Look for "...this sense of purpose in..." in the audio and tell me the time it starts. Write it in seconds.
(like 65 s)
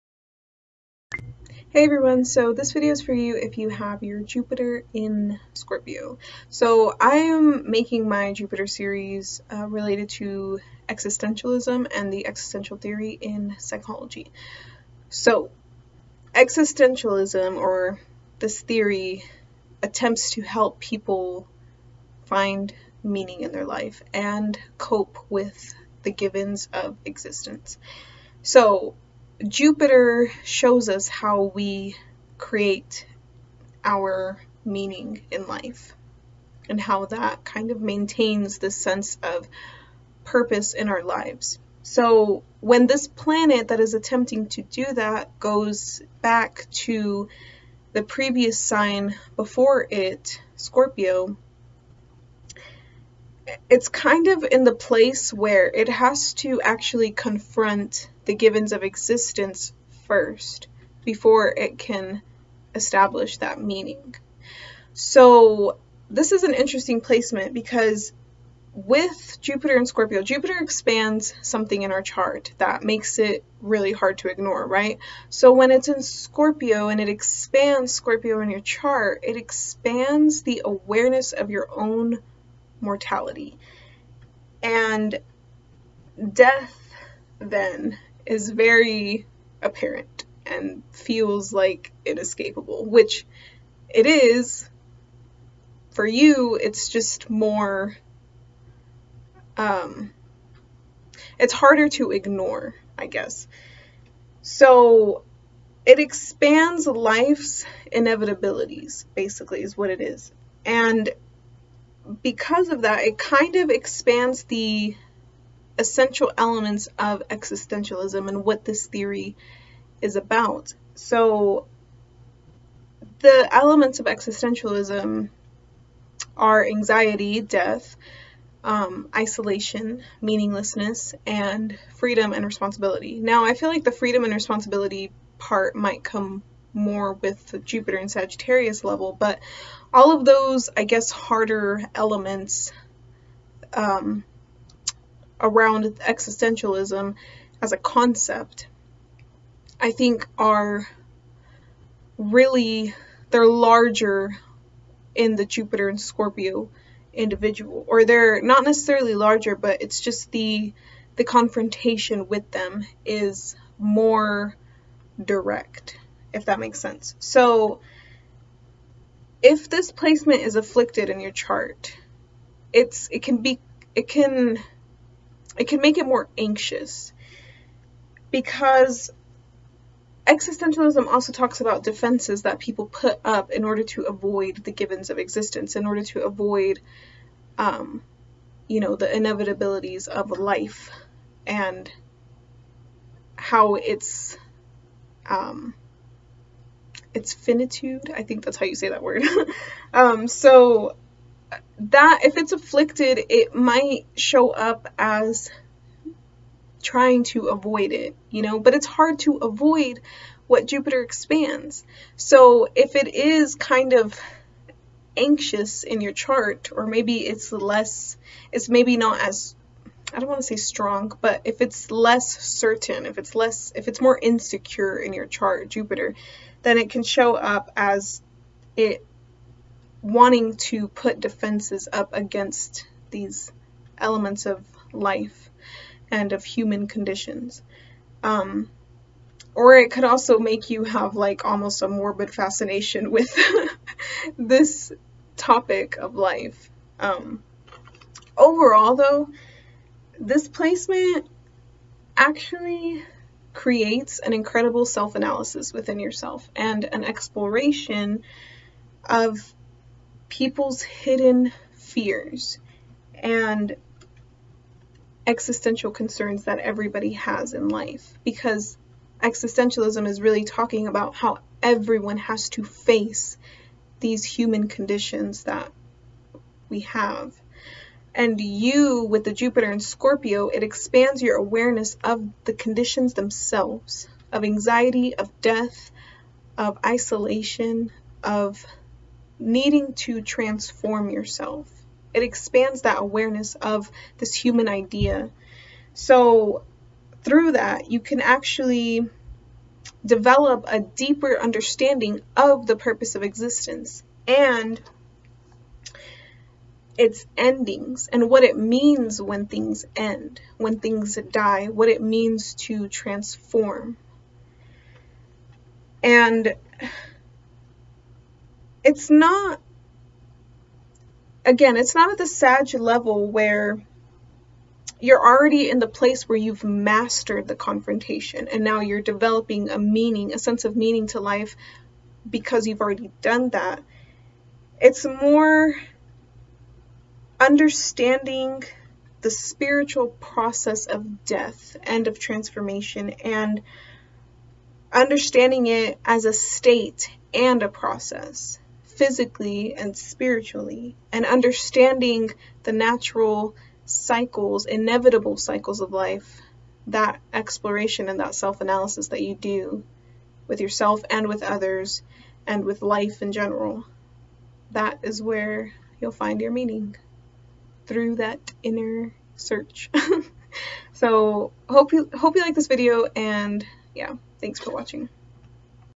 38 s.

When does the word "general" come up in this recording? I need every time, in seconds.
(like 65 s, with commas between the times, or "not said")
363 s.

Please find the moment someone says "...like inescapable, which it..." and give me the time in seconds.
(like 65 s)
91 s.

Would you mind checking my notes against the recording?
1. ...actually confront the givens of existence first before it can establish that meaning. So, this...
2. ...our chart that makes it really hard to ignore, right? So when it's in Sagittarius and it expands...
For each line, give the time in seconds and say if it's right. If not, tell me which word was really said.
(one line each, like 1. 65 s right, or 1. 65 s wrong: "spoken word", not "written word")
1. 56 s right
2. 71 s wrong: "Scorpio", not "Sagittarius".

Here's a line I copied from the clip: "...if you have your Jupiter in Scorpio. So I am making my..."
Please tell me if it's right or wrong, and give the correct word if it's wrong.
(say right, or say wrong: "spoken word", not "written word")
right.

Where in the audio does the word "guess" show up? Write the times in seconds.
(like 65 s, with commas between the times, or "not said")
103 s, 140 s.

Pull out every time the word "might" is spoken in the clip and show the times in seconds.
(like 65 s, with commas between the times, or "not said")
135 s, 203 s.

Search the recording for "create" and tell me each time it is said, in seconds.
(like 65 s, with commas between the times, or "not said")
32 s, 253 s.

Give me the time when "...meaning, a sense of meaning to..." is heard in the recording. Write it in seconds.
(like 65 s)
329 s.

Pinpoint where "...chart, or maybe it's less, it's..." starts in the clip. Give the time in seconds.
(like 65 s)
216 s.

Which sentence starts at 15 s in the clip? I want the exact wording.
So existentialism, or this theory, attempts to help people find meaning in their life and cope with the givens of existence.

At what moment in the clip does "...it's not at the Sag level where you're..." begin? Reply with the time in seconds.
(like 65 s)
321 s.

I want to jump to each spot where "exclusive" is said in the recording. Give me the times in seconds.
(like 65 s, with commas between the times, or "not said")
not said.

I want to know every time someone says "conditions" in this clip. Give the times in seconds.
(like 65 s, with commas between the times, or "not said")
236 s, 274 s, 282 s.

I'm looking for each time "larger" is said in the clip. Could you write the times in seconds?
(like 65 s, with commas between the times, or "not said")
153 s, 159 s.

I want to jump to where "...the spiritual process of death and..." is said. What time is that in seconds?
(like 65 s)
339 s.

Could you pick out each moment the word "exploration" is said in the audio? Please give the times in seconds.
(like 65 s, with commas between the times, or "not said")
257 s, 357 s.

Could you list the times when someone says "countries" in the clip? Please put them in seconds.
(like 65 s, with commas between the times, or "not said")
not said.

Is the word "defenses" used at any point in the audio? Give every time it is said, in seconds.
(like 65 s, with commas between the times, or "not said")
181 s, 231 s.